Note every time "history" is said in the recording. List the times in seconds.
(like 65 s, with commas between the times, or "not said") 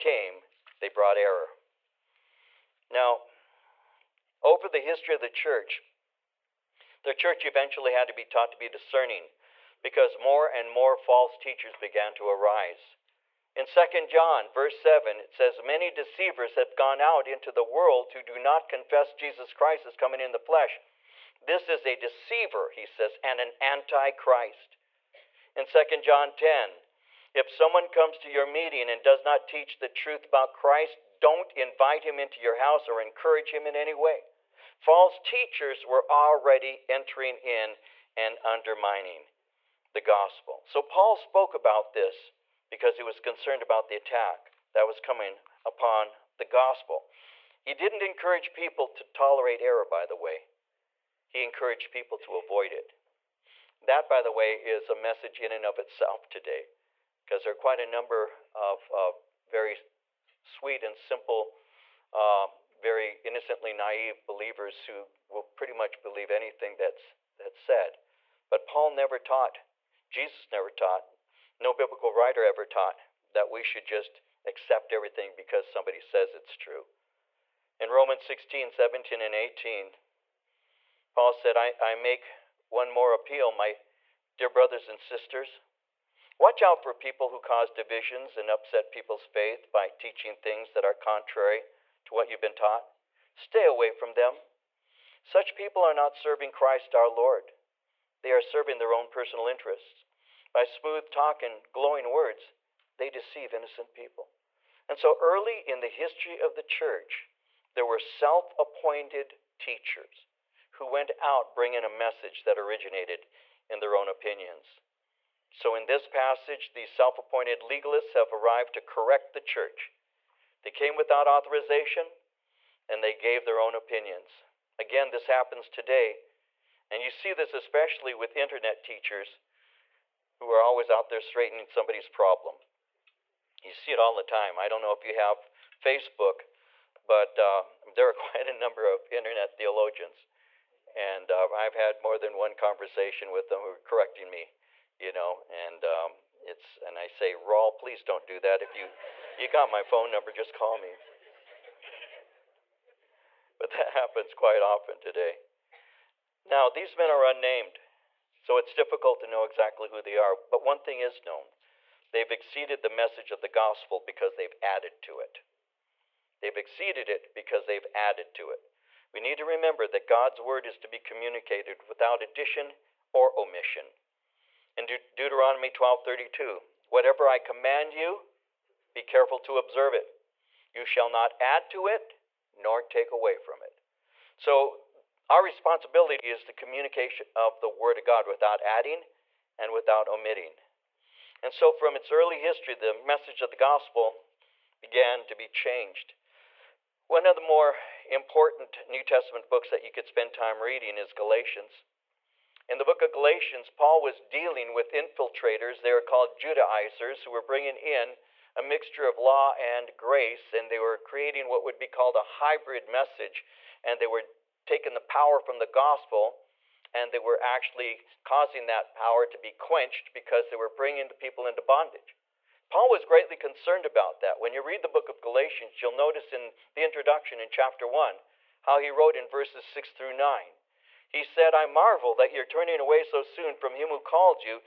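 4 s, 105 s, 192 s.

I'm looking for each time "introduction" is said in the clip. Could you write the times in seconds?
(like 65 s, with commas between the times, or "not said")
226 s.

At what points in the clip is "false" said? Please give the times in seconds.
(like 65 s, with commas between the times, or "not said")
10 s, 34 s.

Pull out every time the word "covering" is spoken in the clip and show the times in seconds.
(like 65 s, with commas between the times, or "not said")
not said.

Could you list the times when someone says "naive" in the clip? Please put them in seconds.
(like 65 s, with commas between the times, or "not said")
63 s.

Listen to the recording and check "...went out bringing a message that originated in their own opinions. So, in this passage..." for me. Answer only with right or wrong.
right.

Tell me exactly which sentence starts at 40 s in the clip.
So Paul spoke about this because he was concerned about the attack that was coming upon the gospel.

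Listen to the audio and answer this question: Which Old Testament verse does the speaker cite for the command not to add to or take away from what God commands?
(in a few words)
Deuteronomy 12:32.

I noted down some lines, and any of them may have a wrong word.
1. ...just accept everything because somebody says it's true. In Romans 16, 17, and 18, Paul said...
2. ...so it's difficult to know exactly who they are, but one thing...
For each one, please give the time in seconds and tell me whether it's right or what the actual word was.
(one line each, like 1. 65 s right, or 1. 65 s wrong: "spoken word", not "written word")
1. 73 s right
2. 158 s right.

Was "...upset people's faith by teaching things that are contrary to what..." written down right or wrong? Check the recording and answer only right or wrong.
right.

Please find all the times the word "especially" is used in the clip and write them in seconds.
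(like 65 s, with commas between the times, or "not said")
127 s.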